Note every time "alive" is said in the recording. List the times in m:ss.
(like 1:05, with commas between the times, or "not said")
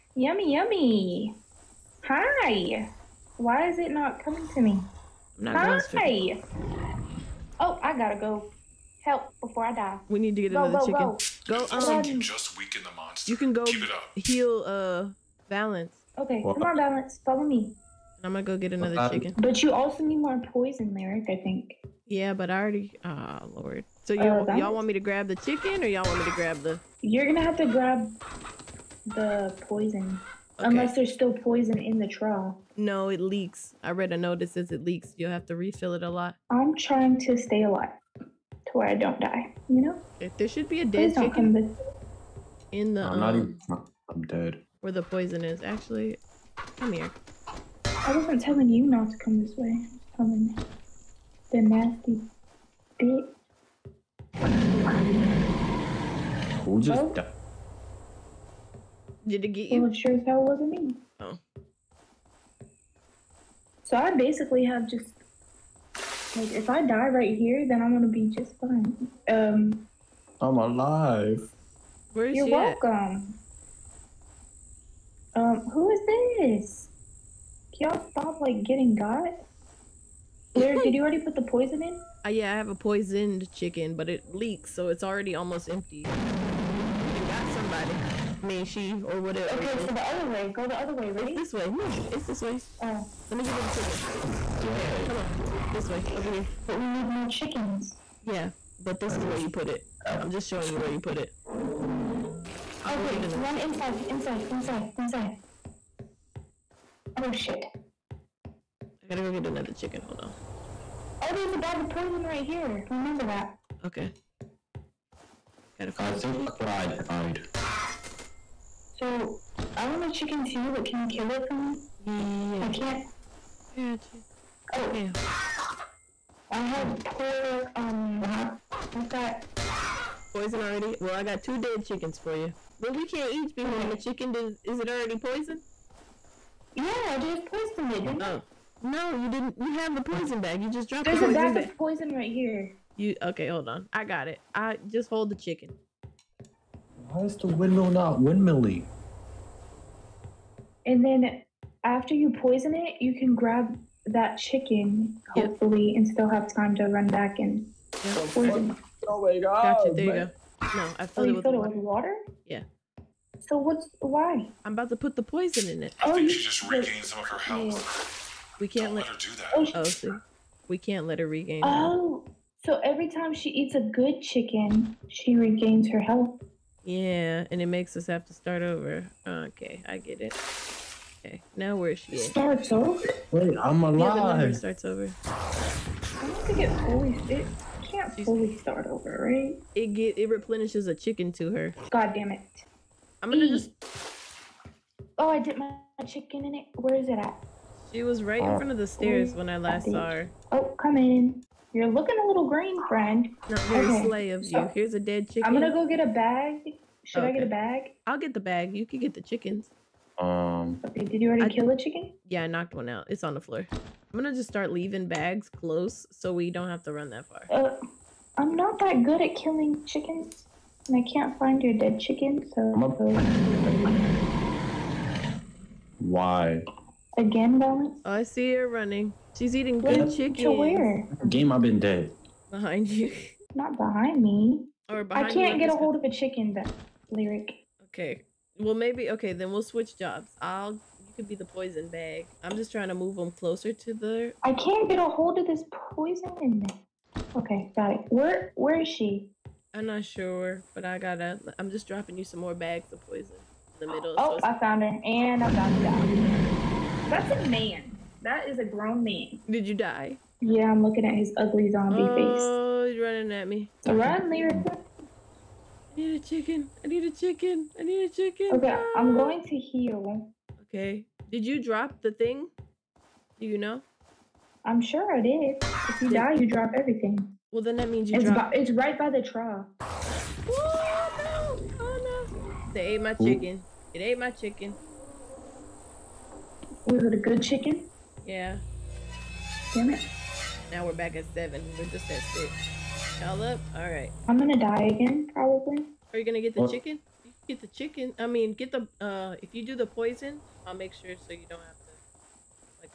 0:37, 1:10, 3:03.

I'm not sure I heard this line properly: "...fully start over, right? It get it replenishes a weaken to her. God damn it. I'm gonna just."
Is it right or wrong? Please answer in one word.
wrong.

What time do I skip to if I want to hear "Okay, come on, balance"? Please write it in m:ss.
0:16.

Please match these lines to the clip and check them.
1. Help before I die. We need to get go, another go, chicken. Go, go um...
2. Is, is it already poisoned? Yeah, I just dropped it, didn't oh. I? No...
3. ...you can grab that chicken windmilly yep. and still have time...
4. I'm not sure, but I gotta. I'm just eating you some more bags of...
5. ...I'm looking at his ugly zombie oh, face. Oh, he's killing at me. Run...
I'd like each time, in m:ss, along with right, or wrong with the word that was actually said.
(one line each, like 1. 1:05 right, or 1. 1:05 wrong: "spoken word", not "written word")
1. 0:09 right
2. 2:14 wrong: "poisoned", not "dropped"
3. 2:32 wrong: "hopefully", not "windmilly"
4. 4:09 wrong: "dropping", not "eating"
5. 4:20 wrong: "running", not "killing".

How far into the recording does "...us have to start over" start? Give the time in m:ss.
2:57.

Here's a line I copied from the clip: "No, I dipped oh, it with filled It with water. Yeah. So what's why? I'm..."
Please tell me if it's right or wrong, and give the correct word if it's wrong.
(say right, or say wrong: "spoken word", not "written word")
wrong: "filled", not "dipped".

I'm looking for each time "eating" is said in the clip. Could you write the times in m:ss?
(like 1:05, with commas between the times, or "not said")
3:49.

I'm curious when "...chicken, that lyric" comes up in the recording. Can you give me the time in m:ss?
3:56.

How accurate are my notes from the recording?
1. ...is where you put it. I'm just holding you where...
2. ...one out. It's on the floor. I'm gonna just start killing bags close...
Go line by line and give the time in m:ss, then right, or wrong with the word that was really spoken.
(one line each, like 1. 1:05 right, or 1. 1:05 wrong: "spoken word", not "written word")
1. 1:39 wrong: "showing", not "holding"
2. 3:32 wrong: "leaving", not "killing".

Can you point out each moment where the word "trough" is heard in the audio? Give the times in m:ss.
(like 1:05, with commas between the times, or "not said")
0:32, 4:39.